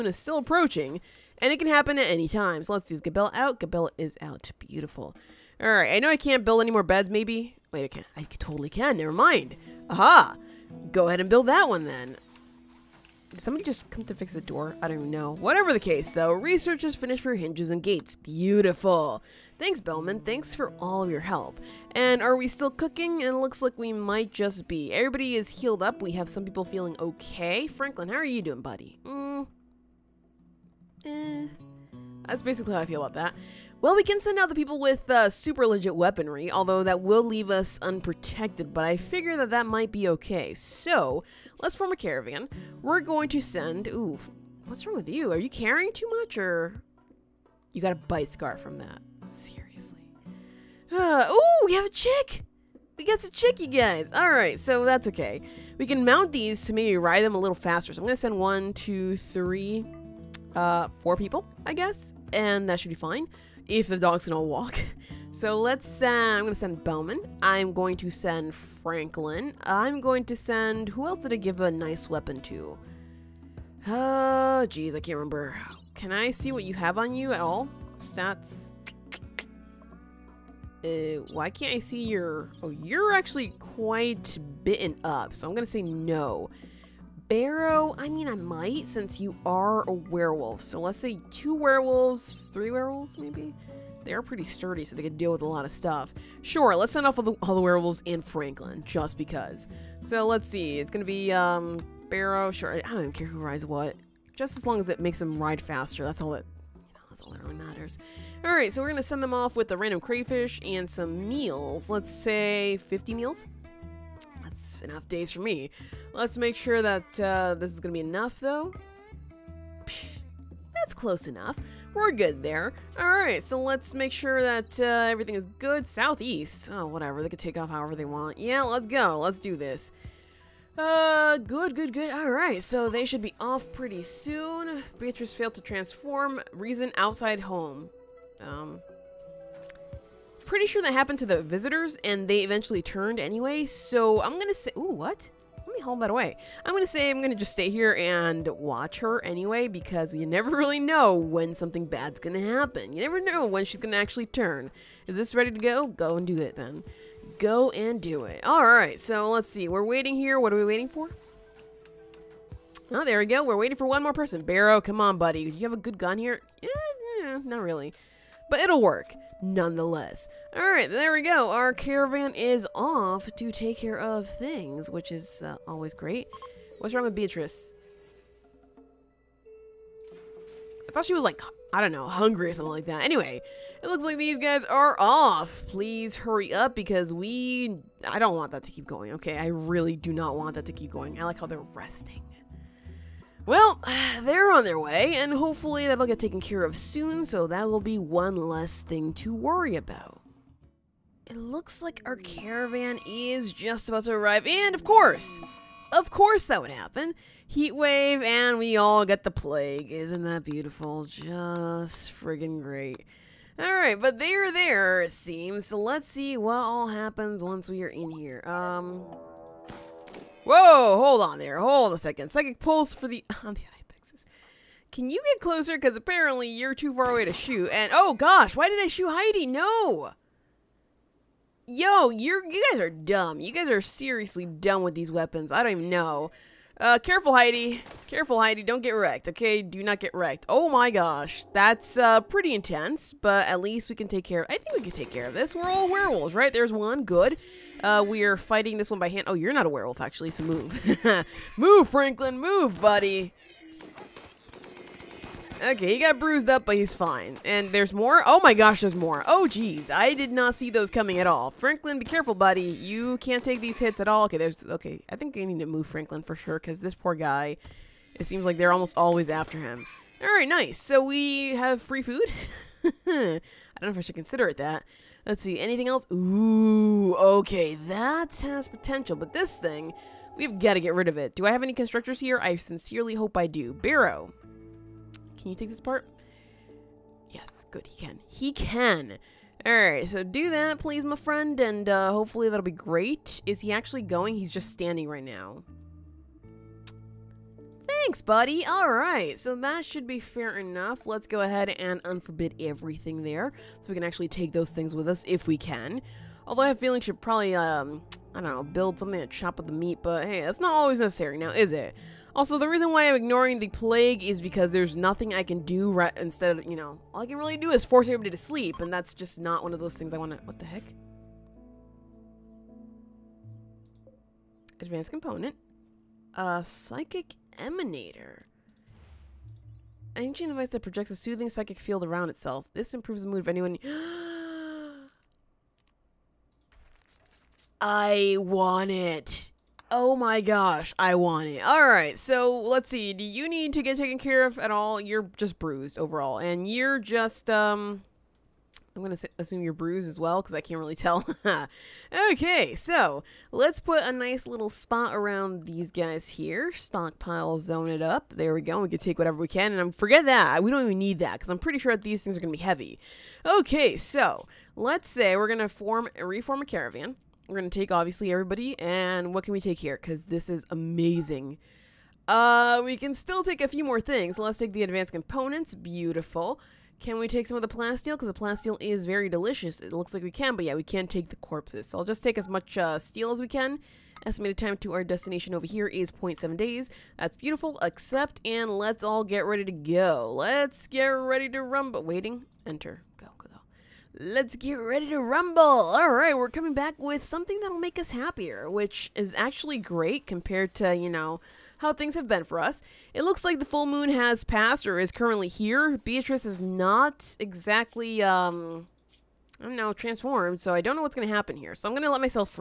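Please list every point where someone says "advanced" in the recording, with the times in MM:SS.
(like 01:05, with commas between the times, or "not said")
05:24, 06:14.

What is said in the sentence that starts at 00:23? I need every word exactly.
And it looks like we might just be.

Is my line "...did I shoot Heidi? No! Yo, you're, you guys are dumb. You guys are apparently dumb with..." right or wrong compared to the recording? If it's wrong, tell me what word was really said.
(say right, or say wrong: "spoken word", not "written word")
wrong: "seriously", not "apparently".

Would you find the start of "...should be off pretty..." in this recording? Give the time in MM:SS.
02:13.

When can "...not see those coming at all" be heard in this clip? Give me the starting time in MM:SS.
04:20.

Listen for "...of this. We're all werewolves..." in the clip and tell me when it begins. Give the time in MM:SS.
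04:05.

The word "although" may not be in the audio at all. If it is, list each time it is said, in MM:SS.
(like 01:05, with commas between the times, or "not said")
00:36, 05:06.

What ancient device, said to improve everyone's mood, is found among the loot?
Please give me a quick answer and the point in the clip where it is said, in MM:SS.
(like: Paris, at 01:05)
Psychic emanator, at 05:26.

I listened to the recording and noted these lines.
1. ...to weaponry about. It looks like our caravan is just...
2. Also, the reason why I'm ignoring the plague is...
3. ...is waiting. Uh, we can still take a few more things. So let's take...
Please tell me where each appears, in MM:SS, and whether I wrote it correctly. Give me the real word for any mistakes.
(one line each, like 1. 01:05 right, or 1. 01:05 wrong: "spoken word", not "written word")
1. 03:19 wrong: "worry", not "weaponry"
2. 05:12 right
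3. 06:10 wrong: "amazing", not "waiting".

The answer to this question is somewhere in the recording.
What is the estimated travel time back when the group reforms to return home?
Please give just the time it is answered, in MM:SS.
06:26.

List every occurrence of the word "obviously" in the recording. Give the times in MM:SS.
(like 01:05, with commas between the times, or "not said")
06:07.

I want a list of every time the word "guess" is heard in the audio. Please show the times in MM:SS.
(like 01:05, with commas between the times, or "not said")
01:01.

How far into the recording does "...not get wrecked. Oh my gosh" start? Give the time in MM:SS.
03:59.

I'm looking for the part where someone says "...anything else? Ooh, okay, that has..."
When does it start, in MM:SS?
04:35.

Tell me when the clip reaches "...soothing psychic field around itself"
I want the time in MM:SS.
05:31.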